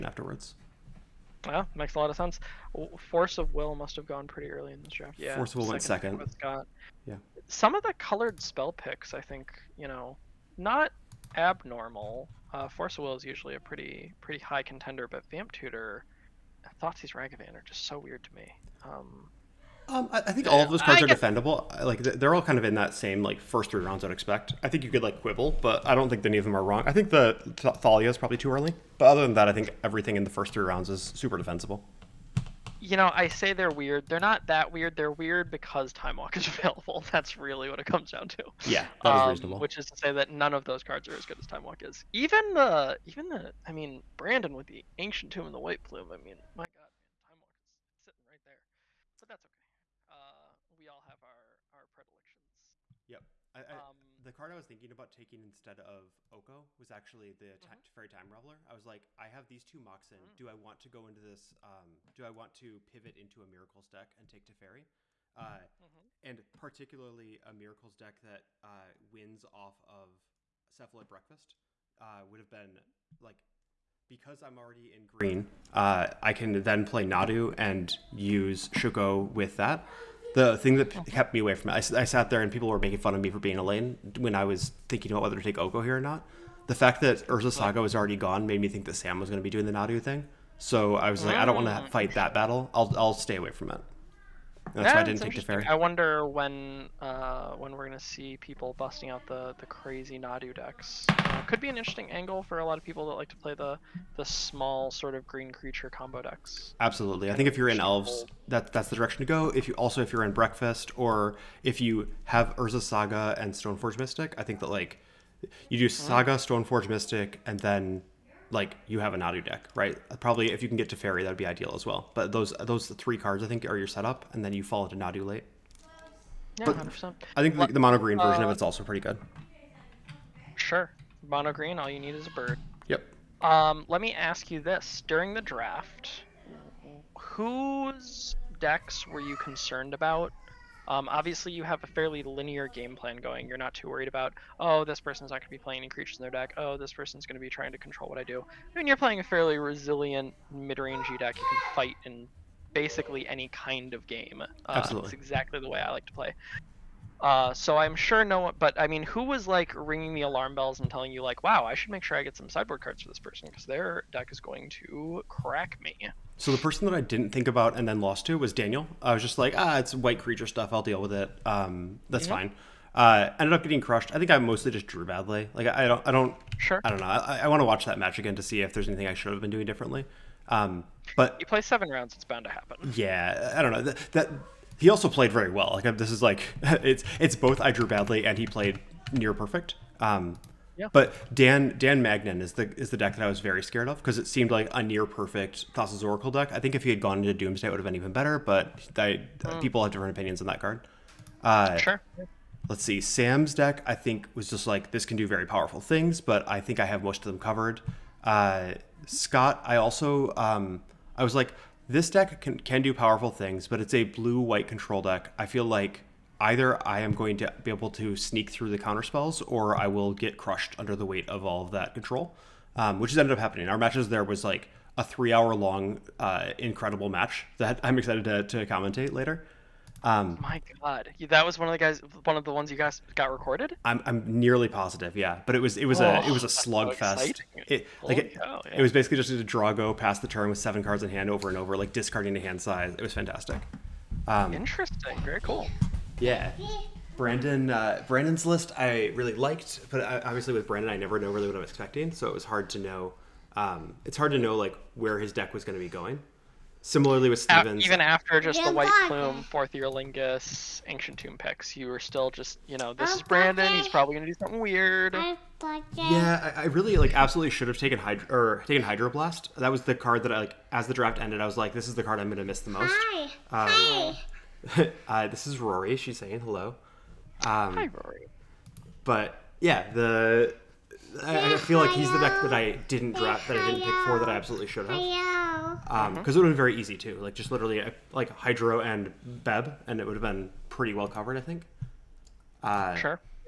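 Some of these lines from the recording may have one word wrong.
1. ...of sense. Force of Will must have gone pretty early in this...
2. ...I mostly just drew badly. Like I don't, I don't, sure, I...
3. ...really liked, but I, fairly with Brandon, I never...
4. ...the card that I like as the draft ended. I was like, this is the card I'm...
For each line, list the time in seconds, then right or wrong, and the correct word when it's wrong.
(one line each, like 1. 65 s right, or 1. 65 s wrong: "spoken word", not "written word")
1. 2 s right
2. 174 s right
3. 249 s wrong: "obviously", not "fairly"
4. 269 s right.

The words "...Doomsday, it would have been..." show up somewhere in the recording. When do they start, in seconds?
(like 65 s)
197 s.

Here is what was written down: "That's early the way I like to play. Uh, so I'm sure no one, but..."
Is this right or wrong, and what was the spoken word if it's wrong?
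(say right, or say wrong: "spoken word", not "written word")
wrong: "exactly", not "early".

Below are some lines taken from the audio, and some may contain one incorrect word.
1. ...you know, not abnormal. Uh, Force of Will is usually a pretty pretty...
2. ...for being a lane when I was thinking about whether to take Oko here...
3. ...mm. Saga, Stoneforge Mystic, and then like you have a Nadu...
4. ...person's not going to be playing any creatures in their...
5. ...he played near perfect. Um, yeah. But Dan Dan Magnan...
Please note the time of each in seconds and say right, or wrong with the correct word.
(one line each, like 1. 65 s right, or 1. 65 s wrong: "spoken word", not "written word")
1. 9 s right
2. 83 s right
3. 115 s right
4. 144 s right
5. 188 s right.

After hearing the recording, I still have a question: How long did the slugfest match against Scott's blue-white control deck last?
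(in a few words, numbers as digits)
3 hours.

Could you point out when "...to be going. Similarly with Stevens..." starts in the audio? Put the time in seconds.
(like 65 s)
255 s.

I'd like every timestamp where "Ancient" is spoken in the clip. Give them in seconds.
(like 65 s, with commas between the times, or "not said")
44 s, 260 s.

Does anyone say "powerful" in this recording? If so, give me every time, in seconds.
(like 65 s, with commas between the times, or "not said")
205 s, 212 s.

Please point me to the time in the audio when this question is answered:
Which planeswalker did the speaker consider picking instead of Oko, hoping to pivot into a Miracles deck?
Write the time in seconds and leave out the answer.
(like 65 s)
57 s.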